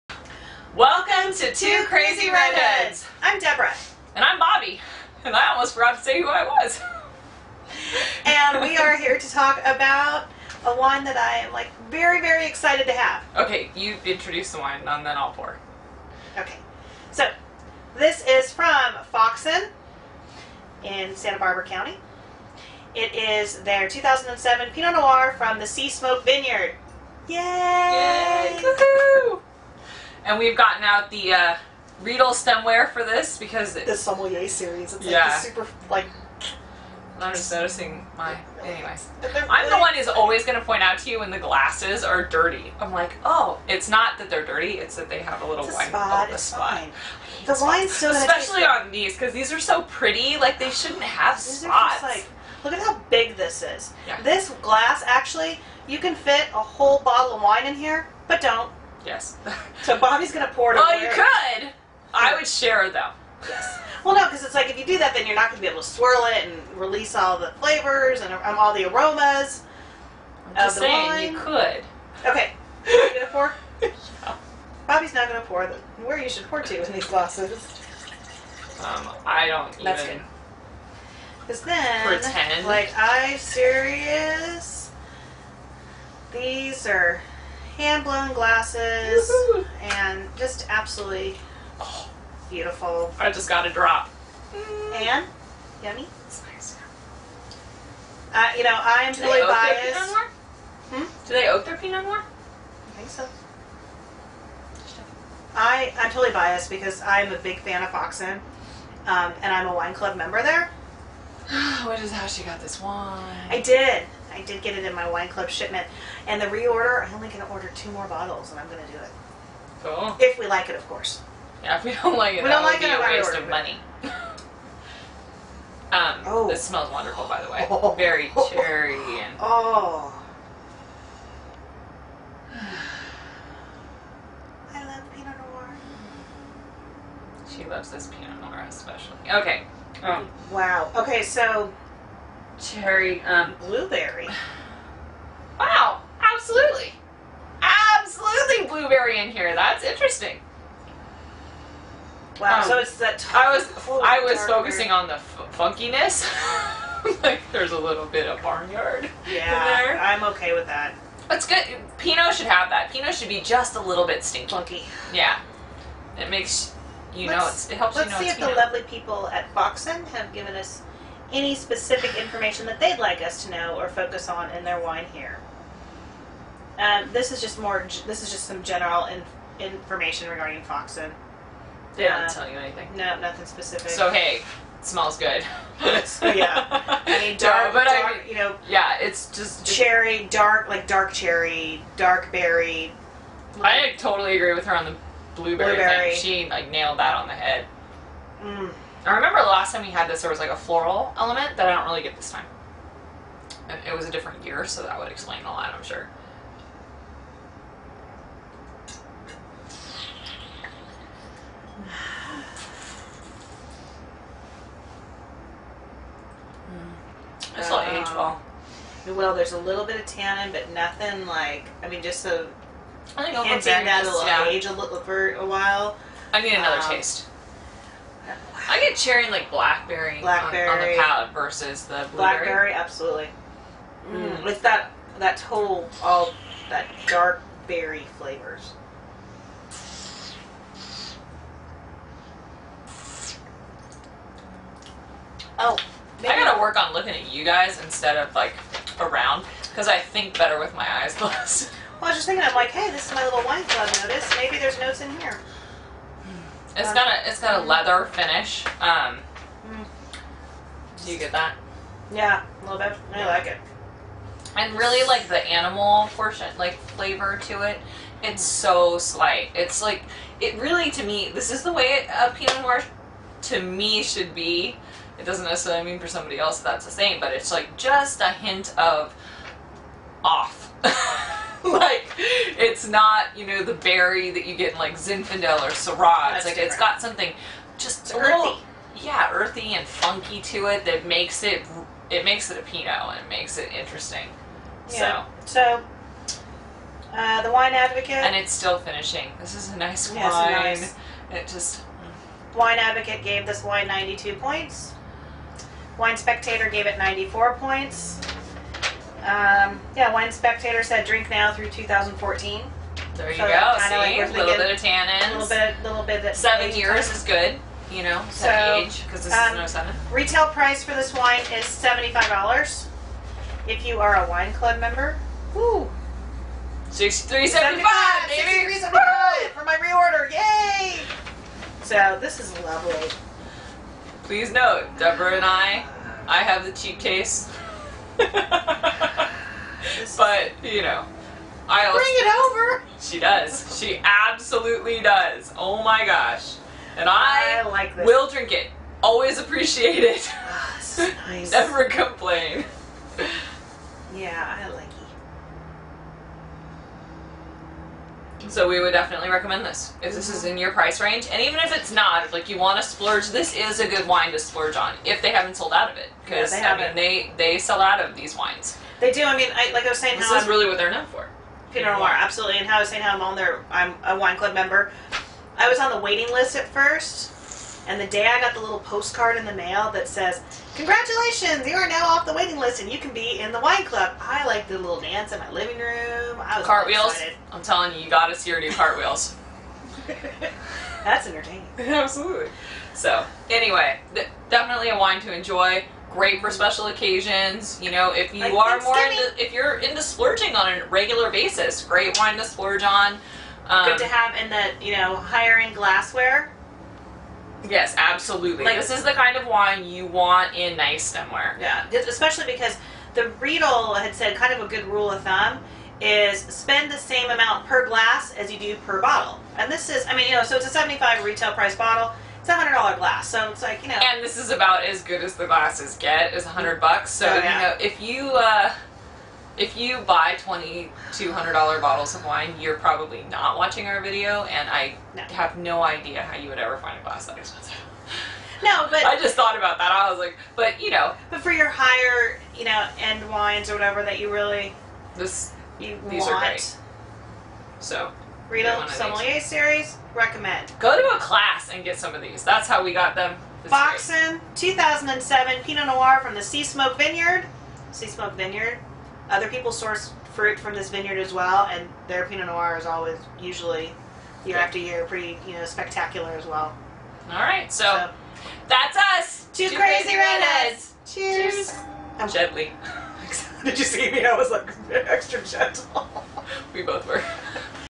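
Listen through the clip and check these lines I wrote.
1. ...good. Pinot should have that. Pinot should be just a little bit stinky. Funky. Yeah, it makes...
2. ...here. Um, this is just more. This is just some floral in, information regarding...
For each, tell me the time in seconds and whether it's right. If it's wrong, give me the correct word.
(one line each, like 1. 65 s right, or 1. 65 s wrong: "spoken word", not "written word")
1. 161 s right
2. 175 s wrong: "general", not "floral".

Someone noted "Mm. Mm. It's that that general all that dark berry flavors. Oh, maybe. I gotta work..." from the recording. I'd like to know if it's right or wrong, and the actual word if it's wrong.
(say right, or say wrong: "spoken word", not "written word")
wrong: "total", not "general".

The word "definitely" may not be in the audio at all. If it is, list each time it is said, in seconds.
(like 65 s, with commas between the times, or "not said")
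358 s, 394 s.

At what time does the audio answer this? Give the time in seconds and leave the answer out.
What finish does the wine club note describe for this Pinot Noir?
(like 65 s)
257 s.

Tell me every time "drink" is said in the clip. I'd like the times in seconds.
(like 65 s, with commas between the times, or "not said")
311 s, 348 s.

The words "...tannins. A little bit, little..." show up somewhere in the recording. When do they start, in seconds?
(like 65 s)
314 s.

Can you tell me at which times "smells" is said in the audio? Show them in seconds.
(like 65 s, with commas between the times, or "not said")
126 s, 184 s.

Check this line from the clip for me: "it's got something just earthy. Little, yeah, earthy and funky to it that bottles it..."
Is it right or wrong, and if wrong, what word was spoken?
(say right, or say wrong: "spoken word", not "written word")
wrong: "makes", not "bottles".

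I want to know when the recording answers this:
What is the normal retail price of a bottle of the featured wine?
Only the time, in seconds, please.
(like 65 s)
321 s.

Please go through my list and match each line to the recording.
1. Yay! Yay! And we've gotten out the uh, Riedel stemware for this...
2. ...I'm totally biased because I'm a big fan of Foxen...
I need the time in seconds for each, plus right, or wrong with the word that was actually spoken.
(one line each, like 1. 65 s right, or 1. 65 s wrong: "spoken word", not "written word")
1. 27 s right
2. 105 s right.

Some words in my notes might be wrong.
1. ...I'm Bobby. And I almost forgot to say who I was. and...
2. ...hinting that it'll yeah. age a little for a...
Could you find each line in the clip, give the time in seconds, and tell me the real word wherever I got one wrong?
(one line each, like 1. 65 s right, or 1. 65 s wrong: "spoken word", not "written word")
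1. 4 s right
2. 223 s right.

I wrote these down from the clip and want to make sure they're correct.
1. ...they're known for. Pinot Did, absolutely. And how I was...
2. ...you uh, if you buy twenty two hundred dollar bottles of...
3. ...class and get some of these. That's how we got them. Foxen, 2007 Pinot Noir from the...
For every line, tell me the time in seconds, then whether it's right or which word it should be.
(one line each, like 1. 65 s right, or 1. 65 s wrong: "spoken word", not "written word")
1. 370 s wrong: "Noir", not "Did"
2. 428 s right
3. 451 s right.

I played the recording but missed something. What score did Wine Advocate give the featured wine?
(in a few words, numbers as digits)
92 points.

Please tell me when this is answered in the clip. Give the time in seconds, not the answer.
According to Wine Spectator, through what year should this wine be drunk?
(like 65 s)
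311 s.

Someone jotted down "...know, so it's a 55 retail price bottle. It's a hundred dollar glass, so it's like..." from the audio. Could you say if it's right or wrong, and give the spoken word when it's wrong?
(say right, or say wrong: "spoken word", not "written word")
wrong: "75", not "55".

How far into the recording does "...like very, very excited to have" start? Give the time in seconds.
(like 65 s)
11 s.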